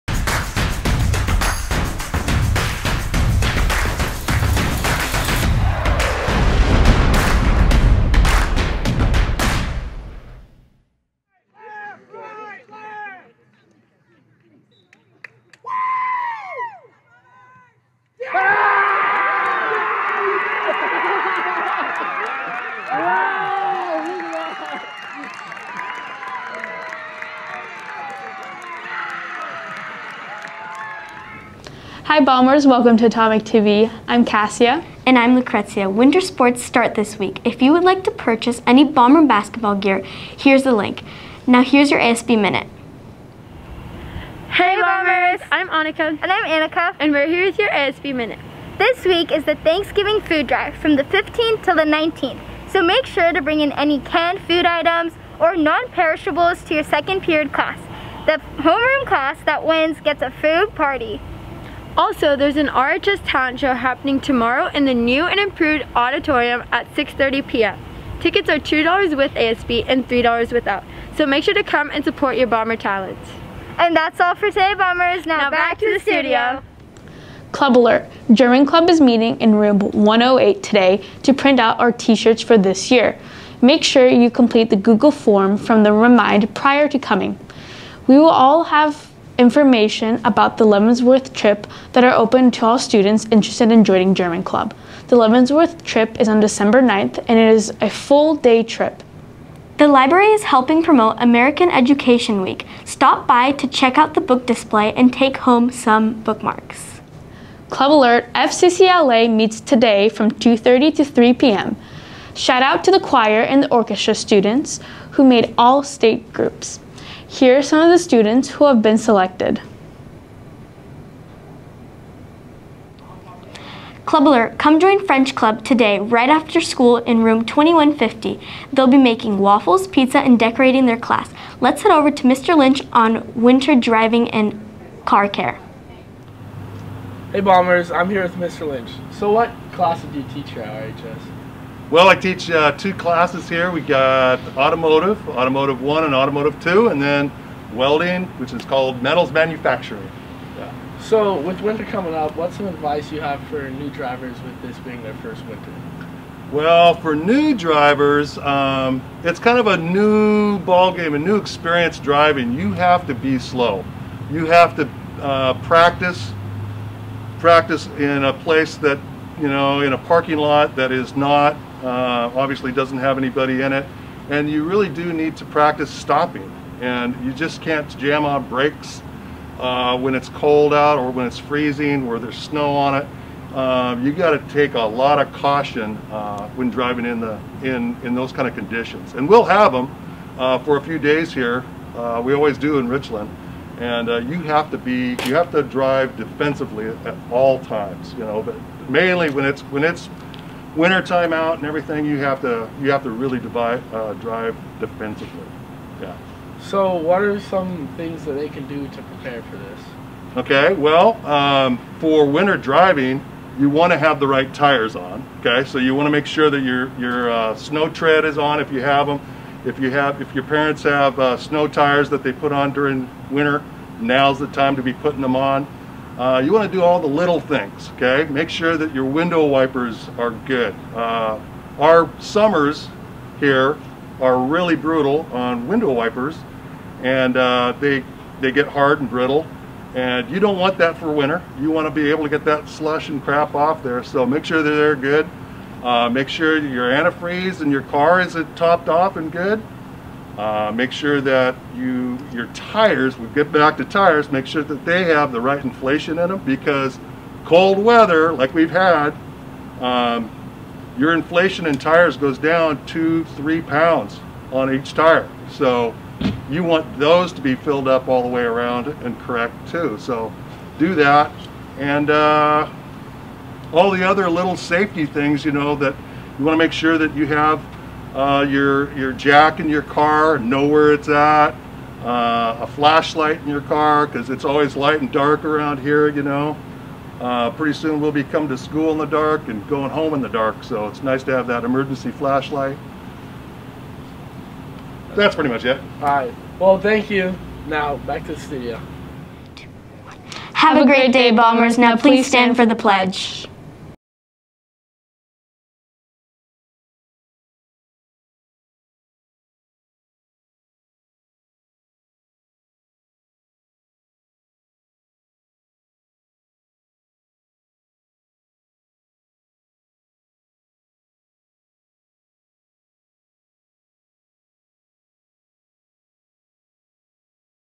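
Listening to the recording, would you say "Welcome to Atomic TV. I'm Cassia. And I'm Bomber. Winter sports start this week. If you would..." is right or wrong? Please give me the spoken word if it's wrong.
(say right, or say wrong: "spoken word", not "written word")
wrong: "Lucrezia", not "Bomber".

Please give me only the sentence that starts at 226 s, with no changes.
Uh, you want to do all the little things, okay?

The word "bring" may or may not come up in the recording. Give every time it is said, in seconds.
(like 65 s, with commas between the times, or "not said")
53 s.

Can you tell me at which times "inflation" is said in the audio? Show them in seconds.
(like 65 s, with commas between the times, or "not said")
255 s, 261 s.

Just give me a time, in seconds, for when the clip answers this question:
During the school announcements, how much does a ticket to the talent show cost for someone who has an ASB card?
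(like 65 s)
68 s.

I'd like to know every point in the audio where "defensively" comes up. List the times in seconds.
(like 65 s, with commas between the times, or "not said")
196 s, 204 s.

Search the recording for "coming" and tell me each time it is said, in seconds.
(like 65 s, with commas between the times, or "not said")
86 s, 151 s, 288 s.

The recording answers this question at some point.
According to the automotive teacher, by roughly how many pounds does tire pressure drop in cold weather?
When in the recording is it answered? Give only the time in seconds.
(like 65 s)
262 s.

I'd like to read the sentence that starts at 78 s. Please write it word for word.
German Club is meeting in room 108 today to print out our t-shirts for this year.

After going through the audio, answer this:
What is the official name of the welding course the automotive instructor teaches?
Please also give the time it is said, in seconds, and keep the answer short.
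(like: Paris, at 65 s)
Metals manufacturing, at 149 s.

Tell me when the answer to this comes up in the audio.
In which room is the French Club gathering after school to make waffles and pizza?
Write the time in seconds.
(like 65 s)
127 s.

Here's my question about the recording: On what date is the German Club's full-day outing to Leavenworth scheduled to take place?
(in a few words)
December 9th.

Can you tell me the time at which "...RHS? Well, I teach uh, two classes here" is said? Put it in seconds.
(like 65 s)
140 s.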